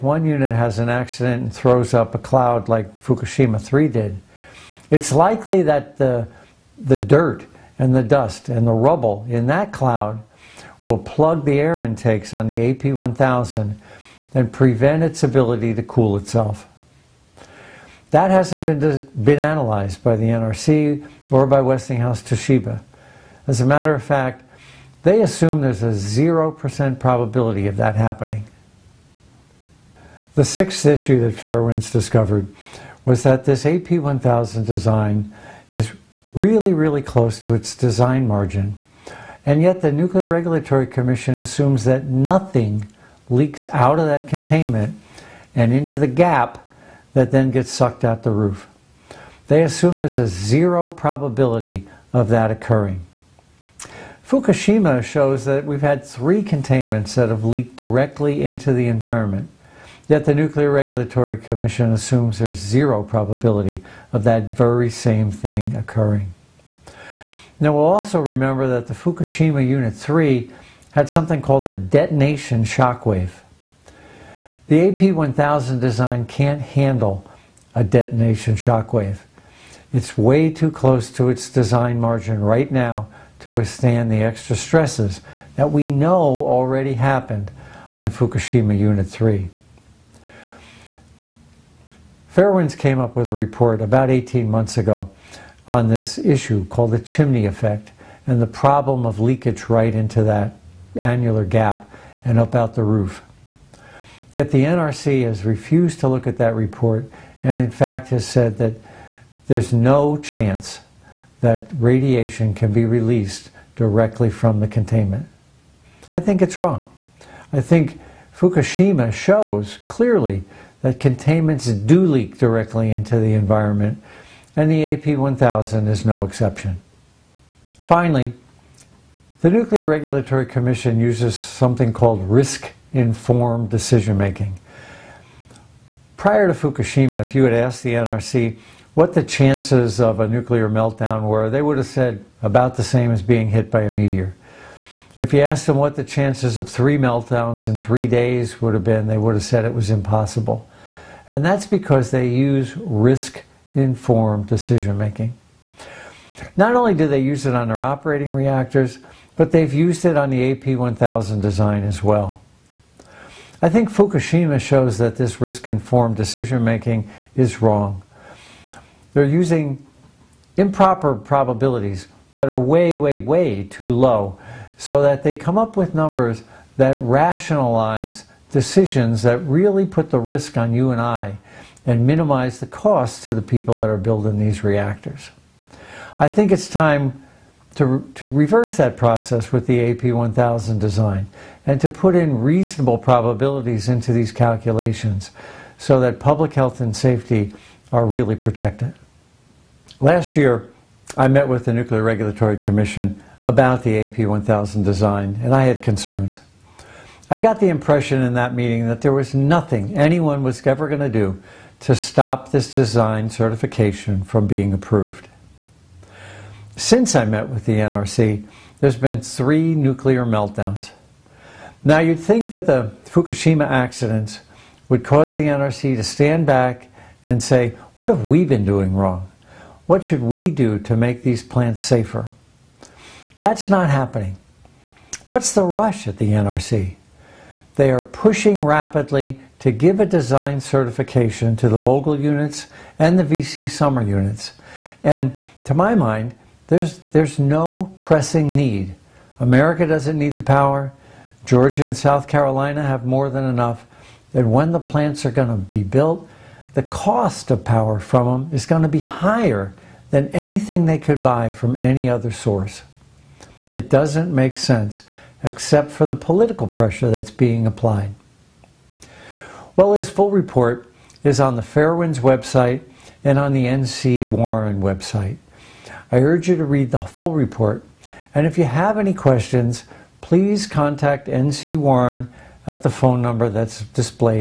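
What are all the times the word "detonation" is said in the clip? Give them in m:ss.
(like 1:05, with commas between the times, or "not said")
1:11, 1:17.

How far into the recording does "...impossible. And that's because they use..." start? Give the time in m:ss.
2:29.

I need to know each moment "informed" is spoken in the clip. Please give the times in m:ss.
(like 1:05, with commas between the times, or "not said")
2:12, 2:33, 2:45.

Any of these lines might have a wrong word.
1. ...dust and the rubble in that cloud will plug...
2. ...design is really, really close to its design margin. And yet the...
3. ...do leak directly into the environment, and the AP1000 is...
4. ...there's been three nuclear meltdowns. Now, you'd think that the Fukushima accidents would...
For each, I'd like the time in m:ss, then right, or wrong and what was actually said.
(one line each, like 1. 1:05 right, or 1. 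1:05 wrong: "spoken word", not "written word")
1. 0:08 right
2. 0:34 right
3. 2:01 right
4. 3:38 right.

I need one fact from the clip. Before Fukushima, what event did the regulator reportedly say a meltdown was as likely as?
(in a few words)
being hit by a meteor.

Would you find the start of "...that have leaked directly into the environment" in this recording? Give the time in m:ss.
0:57.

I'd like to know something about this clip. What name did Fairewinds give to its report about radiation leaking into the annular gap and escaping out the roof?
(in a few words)
the chimney effect.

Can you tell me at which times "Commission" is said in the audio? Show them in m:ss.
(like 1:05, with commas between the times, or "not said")
0:40, 1:01, 2:10, 3:22.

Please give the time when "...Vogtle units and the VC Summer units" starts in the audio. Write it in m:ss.
4:01.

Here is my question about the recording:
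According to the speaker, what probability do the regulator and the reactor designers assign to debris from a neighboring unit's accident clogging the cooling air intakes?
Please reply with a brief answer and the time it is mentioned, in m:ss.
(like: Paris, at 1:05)
0%, at 0:25.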